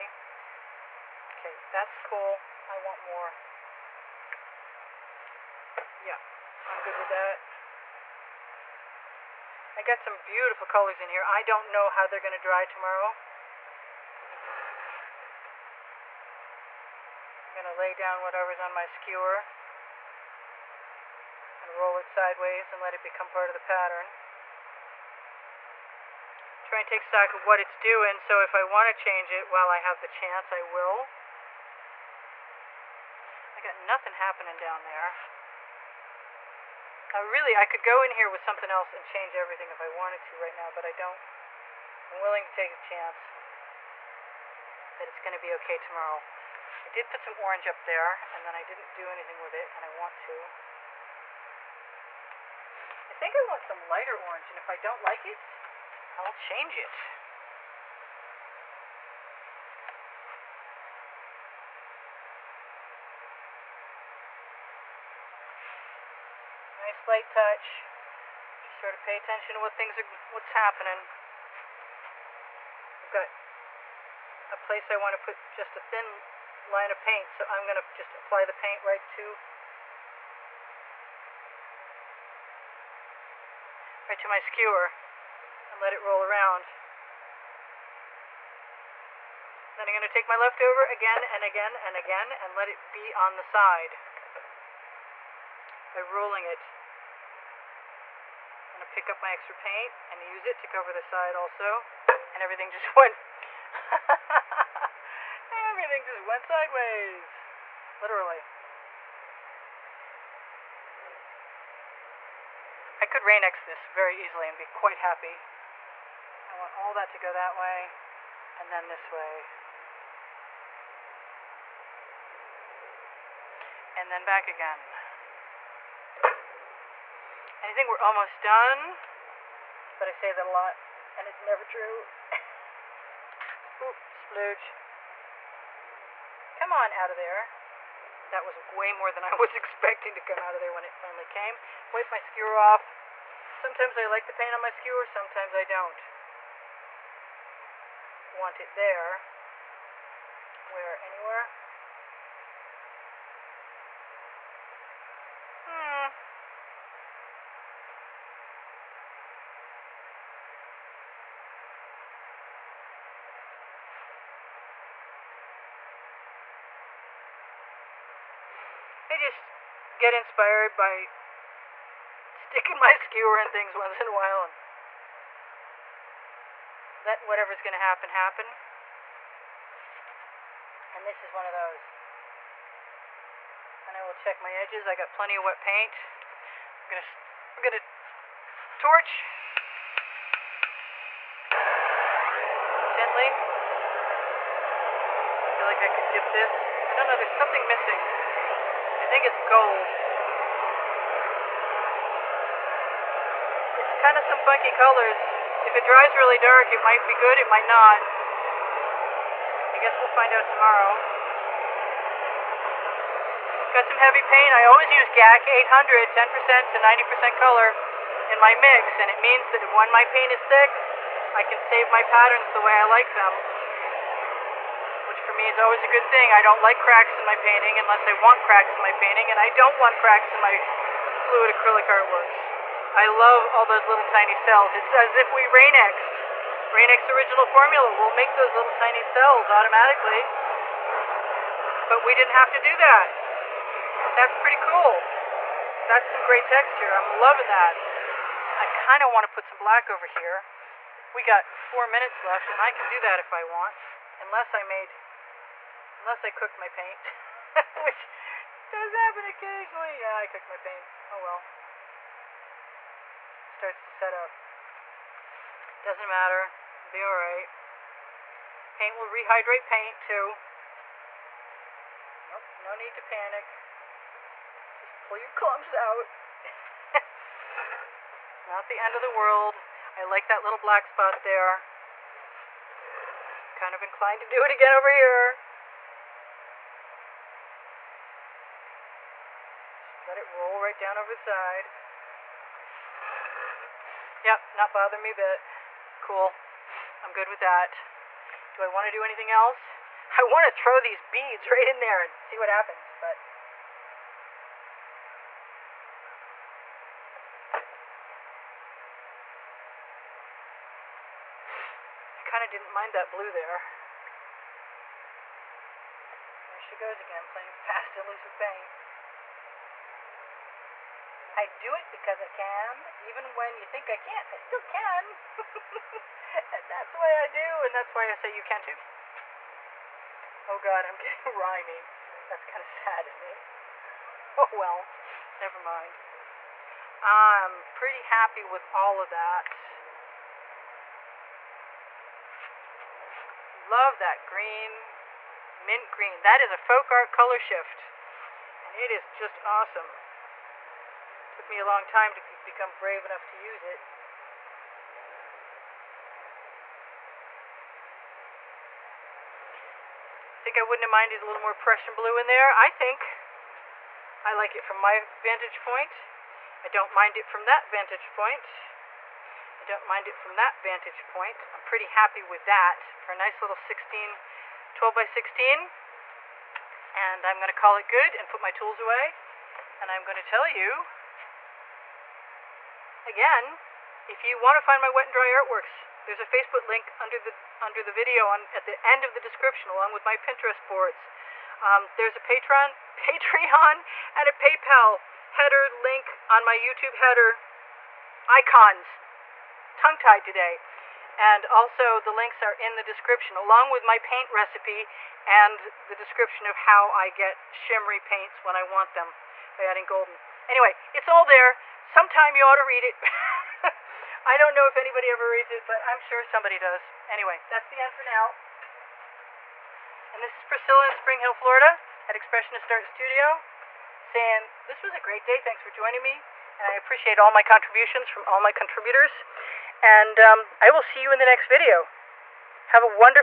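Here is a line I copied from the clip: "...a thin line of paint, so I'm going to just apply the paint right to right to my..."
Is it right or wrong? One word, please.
right.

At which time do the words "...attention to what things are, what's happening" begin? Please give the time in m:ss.
1:09.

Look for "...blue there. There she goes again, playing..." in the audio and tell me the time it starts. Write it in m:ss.
5:13.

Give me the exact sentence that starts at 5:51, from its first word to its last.
Took me a long time to become brave enough to use it.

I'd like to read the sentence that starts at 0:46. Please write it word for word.
I did put some orange up there, and then I didn't do anything with it, and I want to.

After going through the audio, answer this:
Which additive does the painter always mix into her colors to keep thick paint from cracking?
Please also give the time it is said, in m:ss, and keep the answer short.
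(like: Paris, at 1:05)
GAC 800, at 3:35.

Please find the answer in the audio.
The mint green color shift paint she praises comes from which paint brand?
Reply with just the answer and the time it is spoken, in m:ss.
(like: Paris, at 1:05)
Folk Art, at 5:46.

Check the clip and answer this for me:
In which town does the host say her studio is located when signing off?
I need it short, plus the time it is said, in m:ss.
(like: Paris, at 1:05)
Spring Hill, Florida, at 7:00.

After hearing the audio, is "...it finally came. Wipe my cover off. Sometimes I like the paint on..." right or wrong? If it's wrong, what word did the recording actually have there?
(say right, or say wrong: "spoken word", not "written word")
wrong: "skewer", not "cover".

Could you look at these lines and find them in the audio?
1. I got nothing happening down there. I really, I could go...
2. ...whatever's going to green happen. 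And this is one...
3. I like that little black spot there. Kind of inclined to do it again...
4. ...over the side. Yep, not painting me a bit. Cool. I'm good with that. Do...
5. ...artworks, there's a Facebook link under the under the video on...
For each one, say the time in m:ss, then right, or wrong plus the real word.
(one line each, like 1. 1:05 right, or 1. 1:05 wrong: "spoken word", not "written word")
1. 0:33 right
2. 2:57 wrong: "happen", not "green"
3. 4:39 right
4. 4:50 wrong: "bothering", not "painting"
5. 6:25 right.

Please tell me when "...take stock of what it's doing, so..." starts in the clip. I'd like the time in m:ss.
0:26.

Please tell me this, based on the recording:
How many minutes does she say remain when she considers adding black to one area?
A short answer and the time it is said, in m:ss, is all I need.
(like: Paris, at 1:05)
4, at 4:11.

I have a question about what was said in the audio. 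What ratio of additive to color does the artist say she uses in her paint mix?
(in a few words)
10% to 90%.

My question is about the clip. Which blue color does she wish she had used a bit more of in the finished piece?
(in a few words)
Prussian blue.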